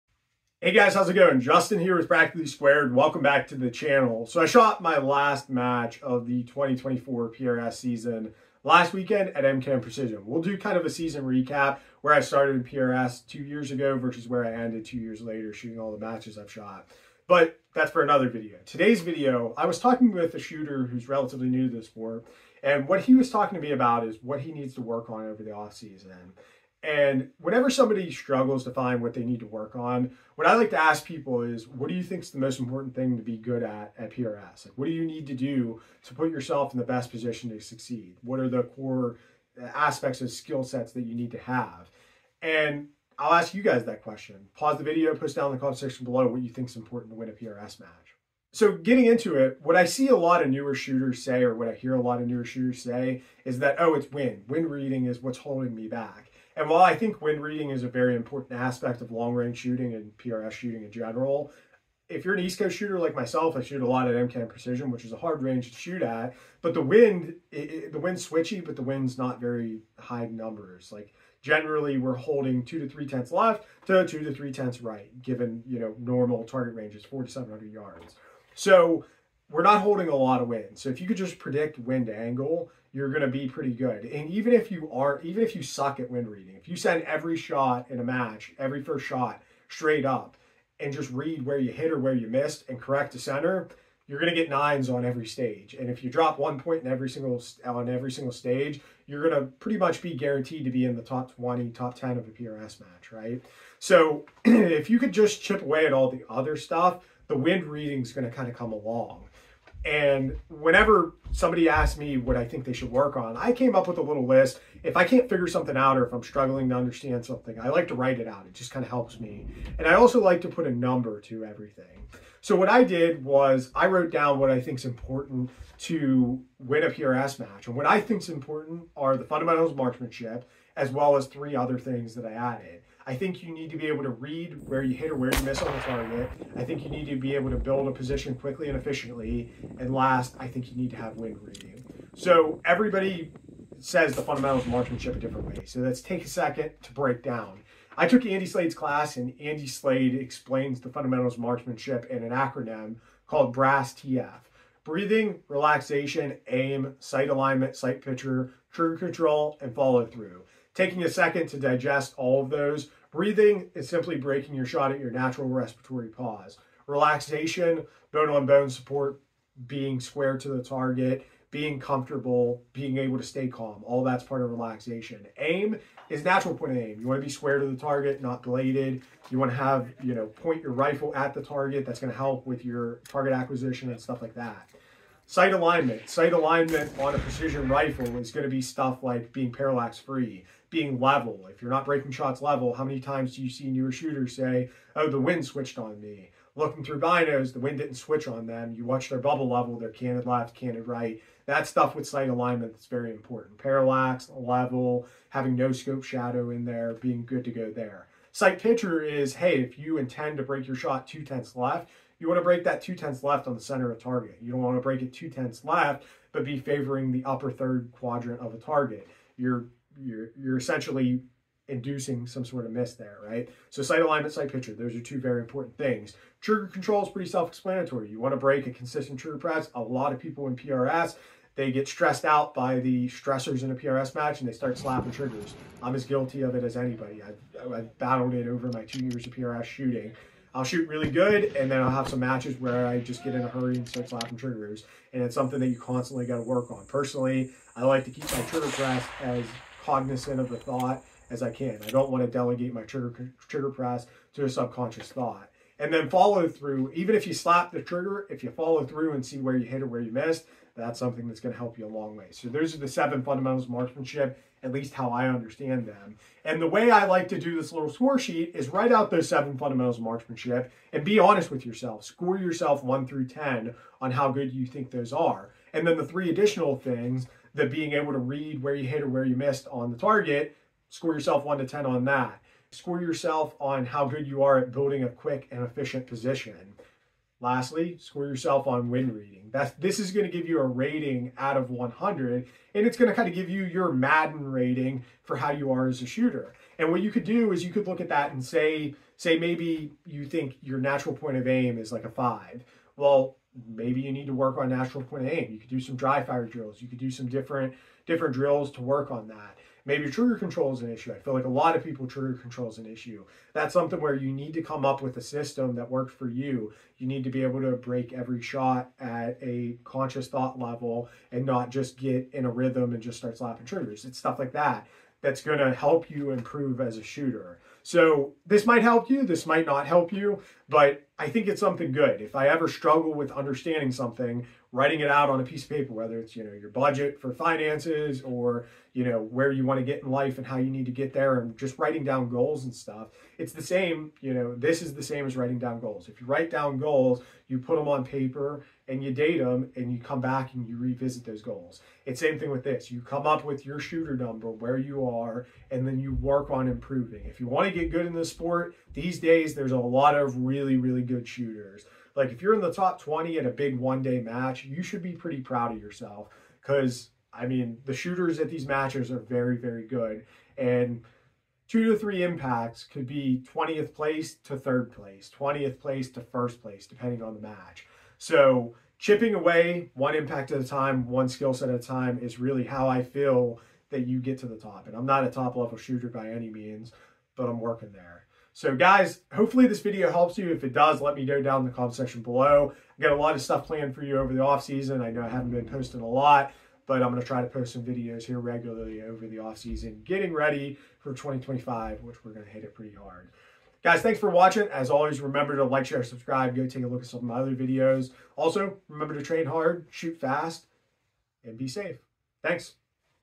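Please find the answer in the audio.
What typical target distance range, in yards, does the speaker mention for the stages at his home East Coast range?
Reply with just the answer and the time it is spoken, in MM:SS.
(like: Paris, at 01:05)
400 to 700 yards, at 01:17.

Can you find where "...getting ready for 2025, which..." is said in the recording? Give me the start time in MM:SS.
06:40.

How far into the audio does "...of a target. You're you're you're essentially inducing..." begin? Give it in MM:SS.
03:38.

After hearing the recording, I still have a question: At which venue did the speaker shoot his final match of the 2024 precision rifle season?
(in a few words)
MKM Precision.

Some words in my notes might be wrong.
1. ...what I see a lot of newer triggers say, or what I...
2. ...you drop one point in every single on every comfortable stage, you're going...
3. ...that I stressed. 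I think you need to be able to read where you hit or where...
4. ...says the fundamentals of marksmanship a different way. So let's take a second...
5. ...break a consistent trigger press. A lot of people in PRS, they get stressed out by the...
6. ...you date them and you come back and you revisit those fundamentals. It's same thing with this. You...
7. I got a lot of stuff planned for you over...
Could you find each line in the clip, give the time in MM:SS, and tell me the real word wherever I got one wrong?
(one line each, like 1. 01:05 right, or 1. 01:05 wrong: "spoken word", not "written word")
1. 00:49 wrong: "shooters", not "triggers"
2. 01:36 wrong: "single", not "comfortable"
3. 02:12 wrong: "added", not "stressed"
4. 02:23 right
5. 03:48 right
6. 05:49 wrong: "goals", not "fundamentals"
7. 06:32 right.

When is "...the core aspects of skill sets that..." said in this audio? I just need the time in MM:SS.
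00:38.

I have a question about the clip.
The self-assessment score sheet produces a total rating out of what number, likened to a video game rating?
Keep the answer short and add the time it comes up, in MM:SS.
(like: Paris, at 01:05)
100, at 04:51.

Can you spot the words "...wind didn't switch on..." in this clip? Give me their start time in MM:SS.
03:17.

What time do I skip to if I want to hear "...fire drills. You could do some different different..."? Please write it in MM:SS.
05:06.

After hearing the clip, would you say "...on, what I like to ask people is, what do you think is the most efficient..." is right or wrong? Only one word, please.
wrong.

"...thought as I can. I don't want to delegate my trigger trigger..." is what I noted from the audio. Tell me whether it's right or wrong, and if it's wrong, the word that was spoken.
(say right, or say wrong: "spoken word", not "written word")
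right.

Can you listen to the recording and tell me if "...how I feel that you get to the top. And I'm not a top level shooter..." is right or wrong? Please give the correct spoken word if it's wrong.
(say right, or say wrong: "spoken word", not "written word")
right.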